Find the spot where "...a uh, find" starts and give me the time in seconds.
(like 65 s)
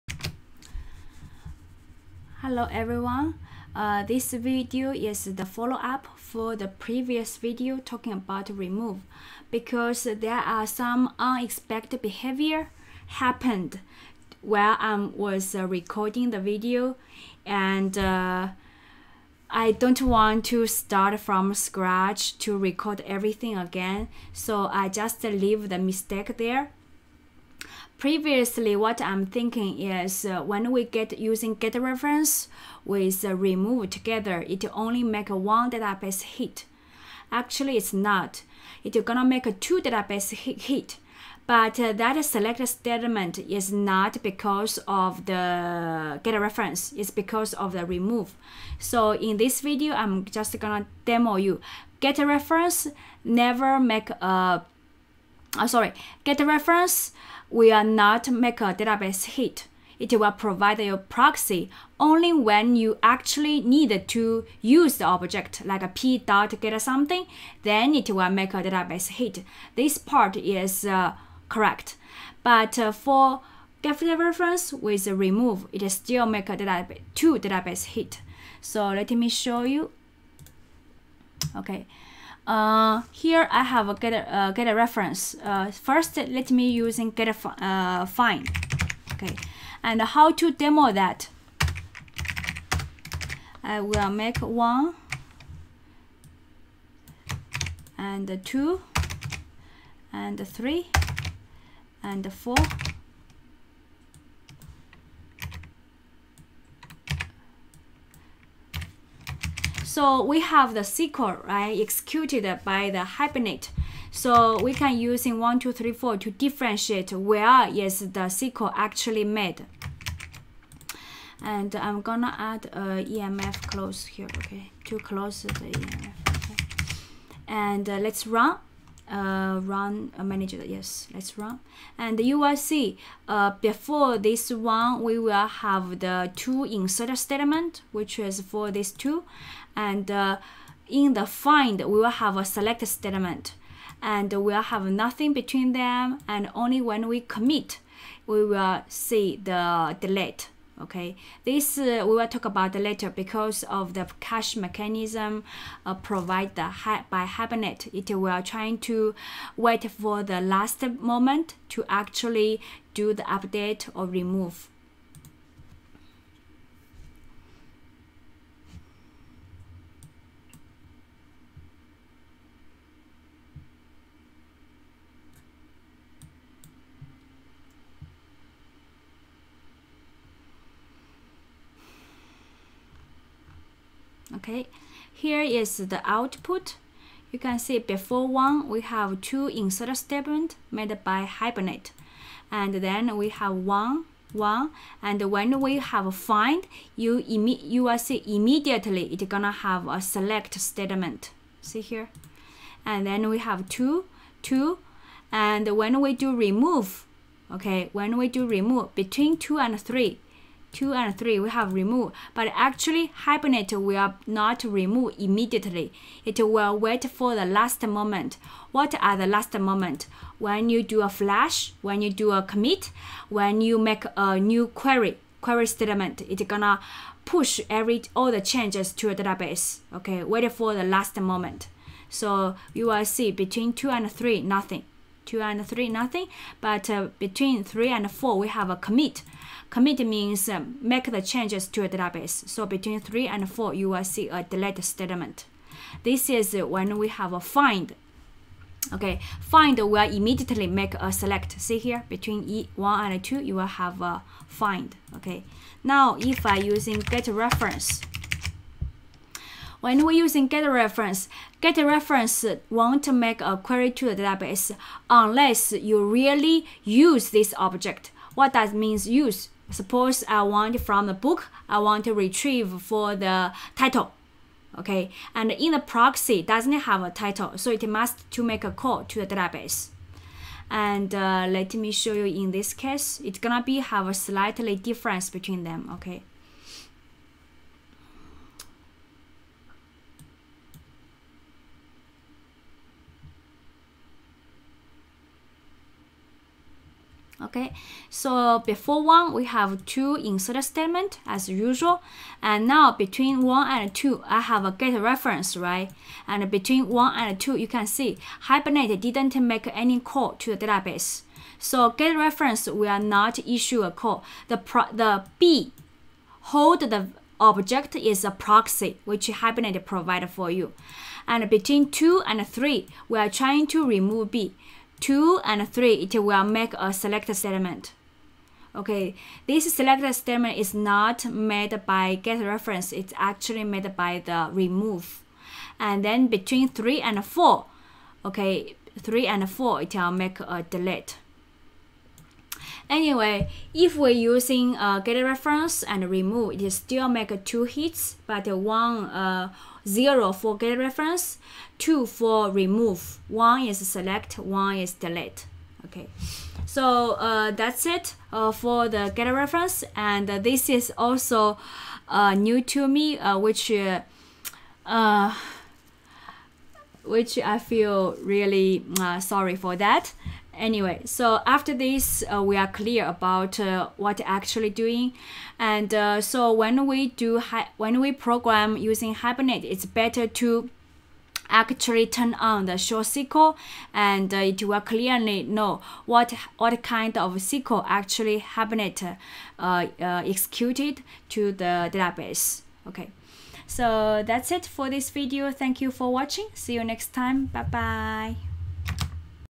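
87 s.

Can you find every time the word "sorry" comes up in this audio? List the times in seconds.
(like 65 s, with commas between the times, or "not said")
55 s, 369 s.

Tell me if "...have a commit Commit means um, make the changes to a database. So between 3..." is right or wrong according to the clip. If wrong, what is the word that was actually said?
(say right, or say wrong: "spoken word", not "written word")
right.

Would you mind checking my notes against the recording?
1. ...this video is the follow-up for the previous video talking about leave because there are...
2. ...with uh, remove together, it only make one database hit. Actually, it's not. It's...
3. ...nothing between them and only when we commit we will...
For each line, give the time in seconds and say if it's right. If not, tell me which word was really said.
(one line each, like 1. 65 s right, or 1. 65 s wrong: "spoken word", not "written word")
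1. 4 s wrong: "remove", not "leave"
2. 32 s right
3. 144 s right.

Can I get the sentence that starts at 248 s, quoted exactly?
Okay, find will immediately make a select.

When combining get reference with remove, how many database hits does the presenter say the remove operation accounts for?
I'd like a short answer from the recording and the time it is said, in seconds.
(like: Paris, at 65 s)
2, at 351 s.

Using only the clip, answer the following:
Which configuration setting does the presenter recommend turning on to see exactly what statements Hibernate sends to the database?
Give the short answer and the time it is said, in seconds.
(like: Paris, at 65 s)
show SQL, at 382 s.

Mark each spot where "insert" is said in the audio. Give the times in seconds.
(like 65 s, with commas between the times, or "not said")
136 s, 189 s, 300 s.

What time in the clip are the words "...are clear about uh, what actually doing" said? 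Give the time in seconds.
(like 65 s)
372 s.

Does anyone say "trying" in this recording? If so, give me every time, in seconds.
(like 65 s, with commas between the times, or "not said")
158 s, 323 s.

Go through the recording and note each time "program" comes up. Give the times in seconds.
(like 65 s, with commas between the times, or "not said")
378 s.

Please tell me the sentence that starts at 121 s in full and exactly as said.
And I'm gonna add a EMF close here, okay, to close the EMF.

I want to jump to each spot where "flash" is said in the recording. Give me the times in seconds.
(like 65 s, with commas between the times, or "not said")
221 s.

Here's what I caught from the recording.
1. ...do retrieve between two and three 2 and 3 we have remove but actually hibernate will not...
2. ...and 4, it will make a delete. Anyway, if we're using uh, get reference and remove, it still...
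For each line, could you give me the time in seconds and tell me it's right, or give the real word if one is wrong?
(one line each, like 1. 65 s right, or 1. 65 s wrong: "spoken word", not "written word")
1. 208 s wrong: "remove", not "retrieve"
2. 339 s right.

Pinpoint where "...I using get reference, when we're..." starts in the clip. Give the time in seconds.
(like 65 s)
256 s.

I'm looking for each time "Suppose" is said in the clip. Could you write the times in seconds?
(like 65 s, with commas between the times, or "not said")
269 s.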